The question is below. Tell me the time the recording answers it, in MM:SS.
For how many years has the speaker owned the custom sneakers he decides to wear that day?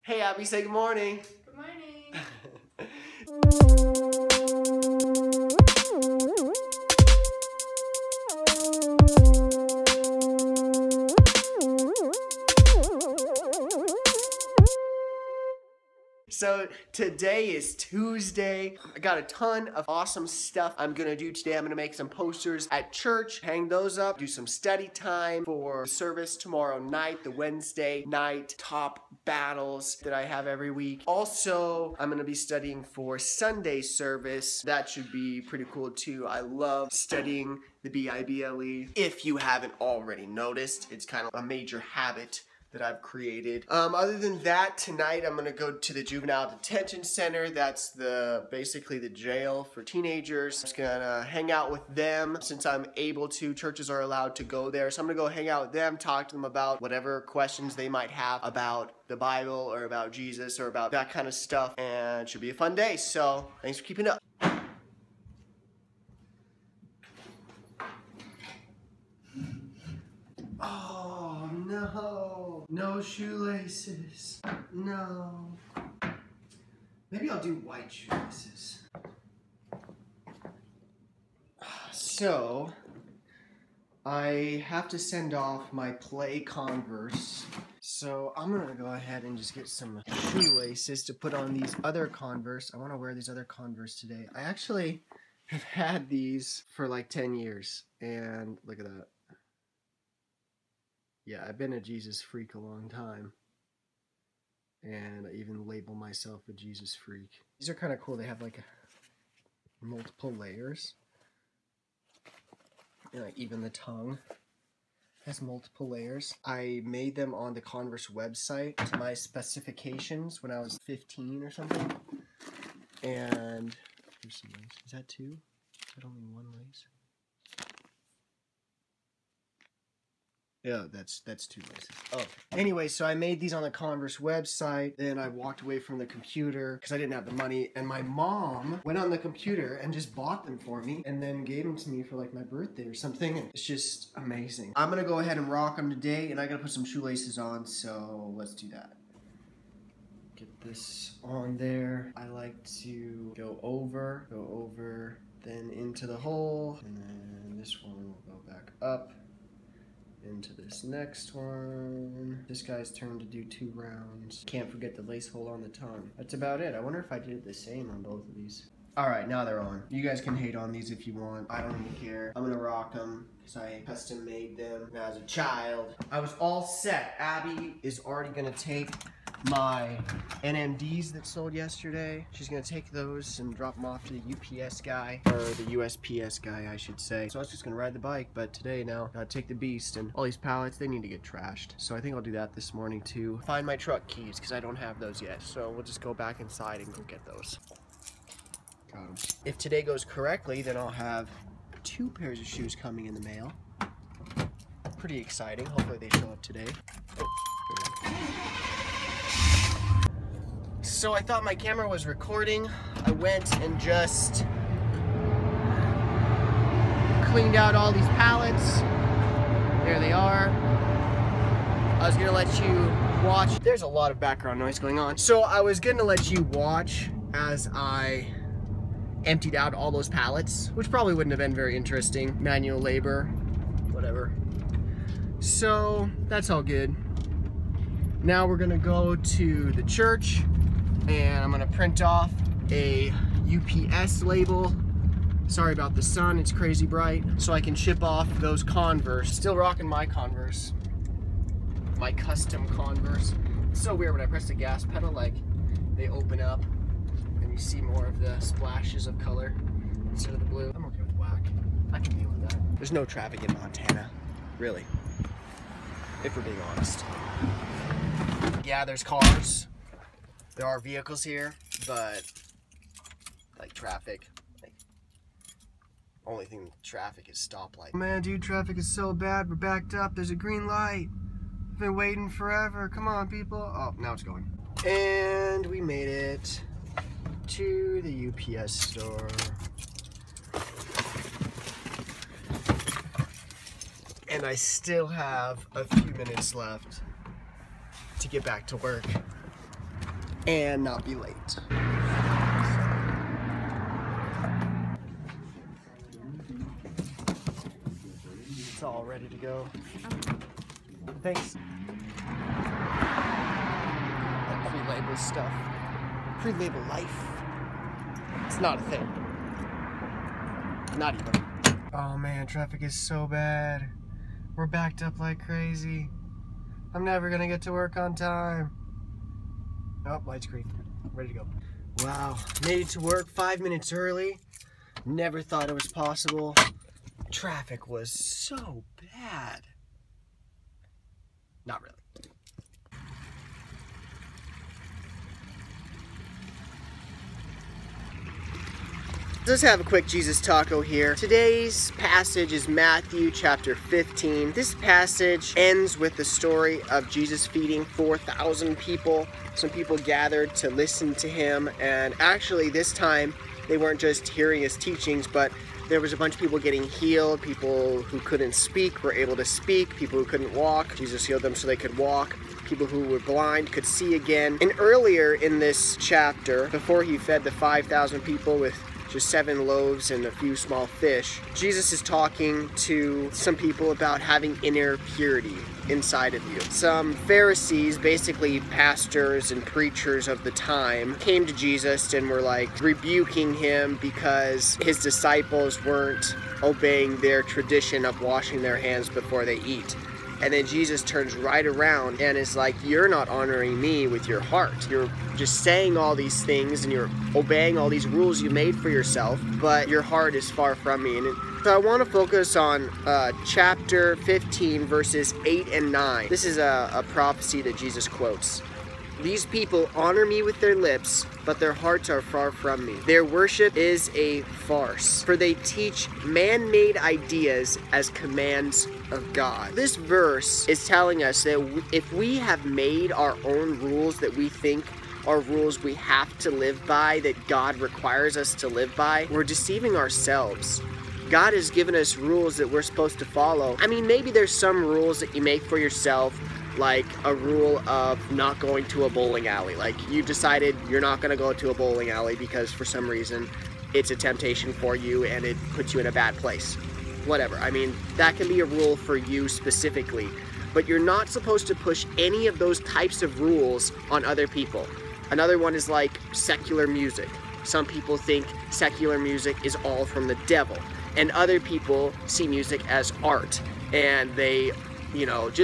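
01:37.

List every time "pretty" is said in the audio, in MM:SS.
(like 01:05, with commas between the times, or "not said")
00:35, 03:24.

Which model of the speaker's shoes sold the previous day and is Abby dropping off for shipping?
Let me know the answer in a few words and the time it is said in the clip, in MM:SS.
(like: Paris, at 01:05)
NMDs, at 03:00.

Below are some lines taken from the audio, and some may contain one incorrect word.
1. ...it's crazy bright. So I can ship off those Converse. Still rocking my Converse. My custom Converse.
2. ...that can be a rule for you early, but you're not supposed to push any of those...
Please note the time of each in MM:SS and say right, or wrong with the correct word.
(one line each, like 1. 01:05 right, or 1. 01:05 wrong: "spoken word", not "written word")
1. 04:06 right
2. 07:38 wrong: "specifically", not "early".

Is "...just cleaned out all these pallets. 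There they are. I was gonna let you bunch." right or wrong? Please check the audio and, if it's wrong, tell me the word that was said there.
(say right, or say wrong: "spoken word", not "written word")
wrong: "watch", not "bunch".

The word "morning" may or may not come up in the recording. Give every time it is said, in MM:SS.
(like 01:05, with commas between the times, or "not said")
00:00, 03:12.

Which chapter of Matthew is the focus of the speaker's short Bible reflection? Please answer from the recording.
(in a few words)
15.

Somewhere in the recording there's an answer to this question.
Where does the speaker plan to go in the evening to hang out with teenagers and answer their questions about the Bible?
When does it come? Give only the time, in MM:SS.
00:46.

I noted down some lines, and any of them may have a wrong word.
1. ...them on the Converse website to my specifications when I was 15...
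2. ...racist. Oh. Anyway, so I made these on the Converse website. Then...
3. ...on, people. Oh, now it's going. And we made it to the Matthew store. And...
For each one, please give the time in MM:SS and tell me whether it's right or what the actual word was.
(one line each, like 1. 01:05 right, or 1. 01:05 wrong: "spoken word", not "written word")
1. 01:57 right
2. 02:11 right
3. 04:43 wrong: "UPS", not "Matthew".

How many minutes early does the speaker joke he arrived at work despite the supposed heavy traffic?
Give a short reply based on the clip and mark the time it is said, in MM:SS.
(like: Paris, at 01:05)
5, at 05:33.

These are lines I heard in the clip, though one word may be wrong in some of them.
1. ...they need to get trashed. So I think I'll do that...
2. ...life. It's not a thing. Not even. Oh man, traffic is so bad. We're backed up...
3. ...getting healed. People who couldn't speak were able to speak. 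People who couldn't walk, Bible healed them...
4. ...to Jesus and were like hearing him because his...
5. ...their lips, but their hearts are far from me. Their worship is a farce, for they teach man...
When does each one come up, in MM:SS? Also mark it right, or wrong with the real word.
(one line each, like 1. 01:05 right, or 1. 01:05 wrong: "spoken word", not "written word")
1. 03:10 right
2. 05:16 right
3. 06:06 wrong: "Jesus", not "Bible"
4. 06:31 wrong: "rebuking", not "hearing"
5. 07:00 right.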